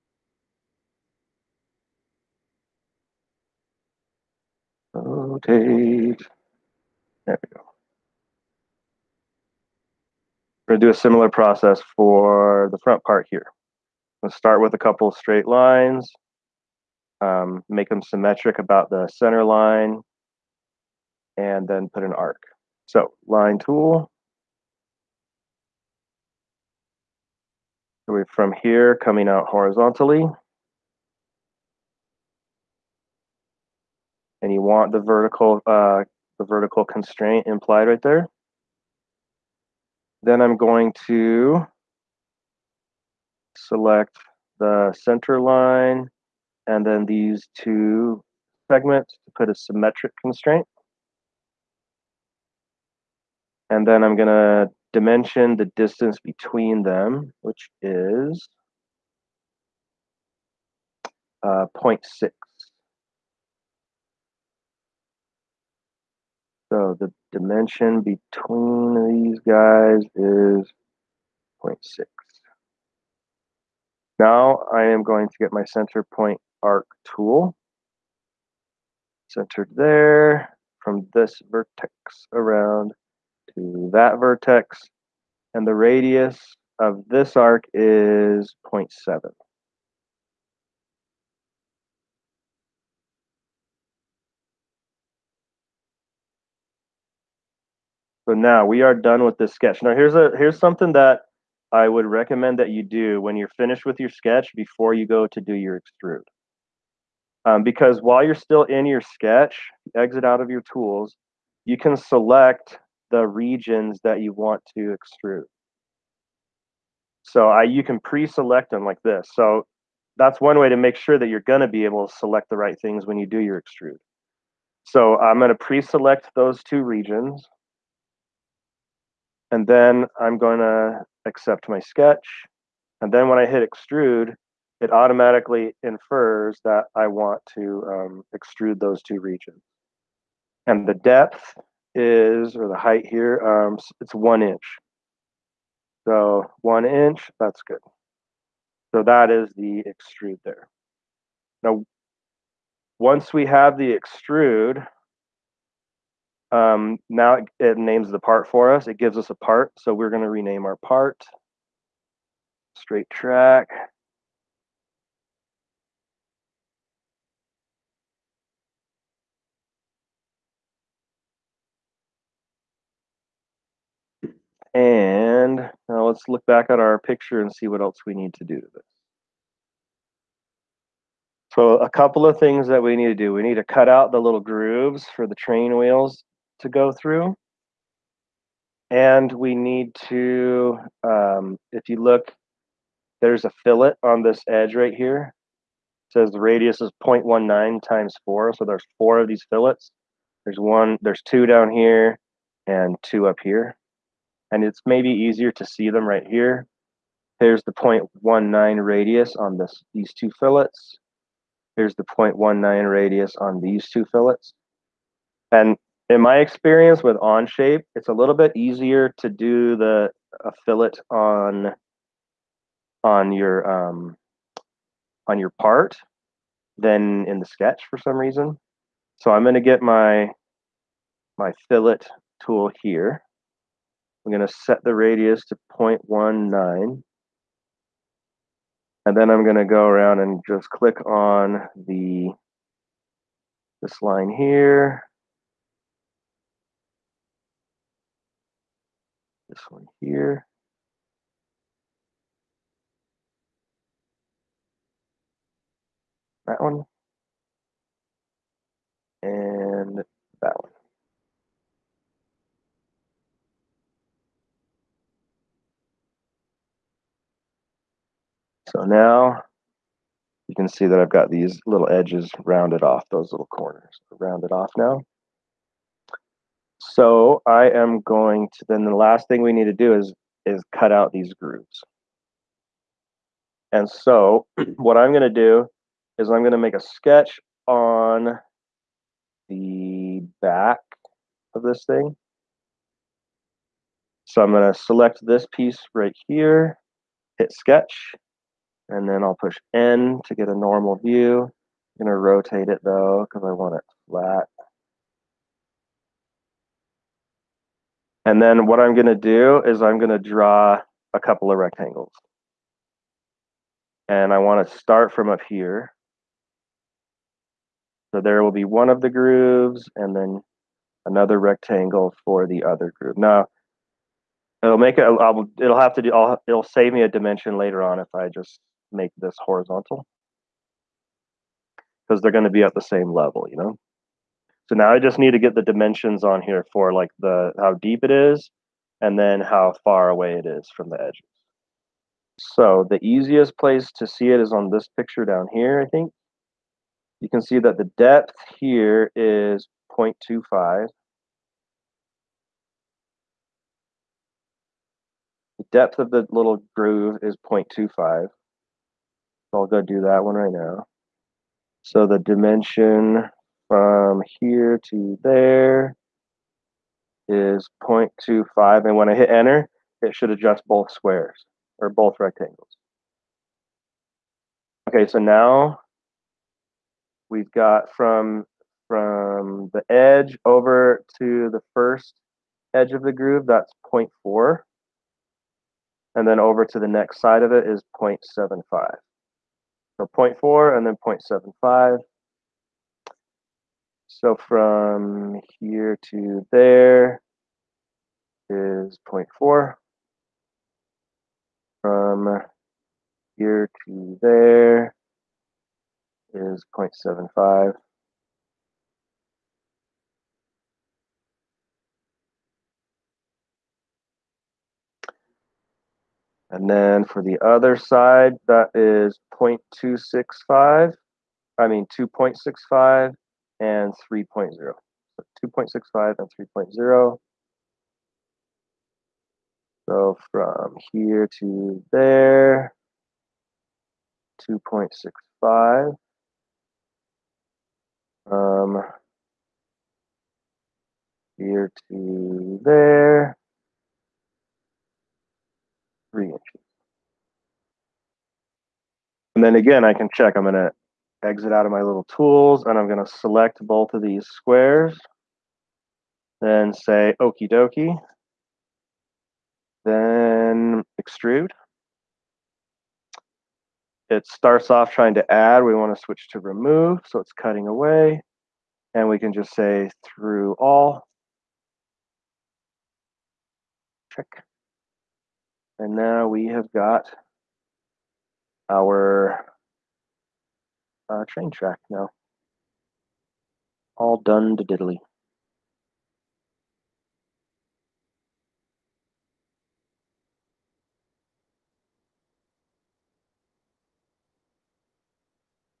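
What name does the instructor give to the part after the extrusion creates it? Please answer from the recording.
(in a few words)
Straight track.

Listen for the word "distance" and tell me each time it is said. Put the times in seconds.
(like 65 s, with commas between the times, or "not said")
55 s.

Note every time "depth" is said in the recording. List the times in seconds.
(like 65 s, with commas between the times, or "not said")
140 s, 347 s, 355 s.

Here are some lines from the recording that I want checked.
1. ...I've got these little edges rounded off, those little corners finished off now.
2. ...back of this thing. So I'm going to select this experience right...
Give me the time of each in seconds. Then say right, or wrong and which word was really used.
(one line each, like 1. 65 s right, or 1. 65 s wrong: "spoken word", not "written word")
1. 270 s wrong: "rounded", not "finished"
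2. 290 s wrong: "piece", not "experience".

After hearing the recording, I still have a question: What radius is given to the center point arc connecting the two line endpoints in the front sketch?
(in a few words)
0.7.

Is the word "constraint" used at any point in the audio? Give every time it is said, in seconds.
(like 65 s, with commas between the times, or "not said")
36 s, 50 s.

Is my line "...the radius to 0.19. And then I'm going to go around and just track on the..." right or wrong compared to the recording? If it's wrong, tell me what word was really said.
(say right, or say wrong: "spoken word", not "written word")
wrong: "click", not "track".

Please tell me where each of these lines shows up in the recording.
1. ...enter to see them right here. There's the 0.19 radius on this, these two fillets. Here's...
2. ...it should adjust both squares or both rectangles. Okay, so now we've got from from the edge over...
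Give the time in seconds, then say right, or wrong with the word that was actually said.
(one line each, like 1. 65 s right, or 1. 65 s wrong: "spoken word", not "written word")
1. 205 s wrong: "easier", not "enter"
2. 370 s right.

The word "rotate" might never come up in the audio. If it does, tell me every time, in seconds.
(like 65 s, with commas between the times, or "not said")
4 s, 302 s.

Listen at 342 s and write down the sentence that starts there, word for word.
So the easiest place to see it is on this picture down here, I think.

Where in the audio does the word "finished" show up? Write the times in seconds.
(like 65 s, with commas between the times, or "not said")
103 s.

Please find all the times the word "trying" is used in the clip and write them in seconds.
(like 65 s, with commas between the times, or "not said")
464 s.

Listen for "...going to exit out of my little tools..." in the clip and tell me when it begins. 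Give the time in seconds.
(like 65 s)
450 s.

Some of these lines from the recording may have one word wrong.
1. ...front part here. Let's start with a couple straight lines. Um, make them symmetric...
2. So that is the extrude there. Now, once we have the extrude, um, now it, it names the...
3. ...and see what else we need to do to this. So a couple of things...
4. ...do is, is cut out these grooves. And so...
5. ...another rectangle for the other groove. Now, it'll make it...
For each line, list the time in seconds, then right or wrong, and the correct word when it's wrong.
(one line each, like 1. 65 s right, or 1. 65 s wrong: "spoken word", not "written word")
1. 12 s right
2. 148 s right
3. 177 s right
4. 279 s right
5. 321 s right.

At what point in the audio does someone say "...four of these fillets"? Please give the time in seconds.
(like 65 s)
198 s.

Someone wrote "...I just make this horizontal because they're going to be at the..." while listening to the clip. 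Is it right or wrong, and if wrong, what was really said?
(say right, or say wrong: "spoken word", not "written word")
right.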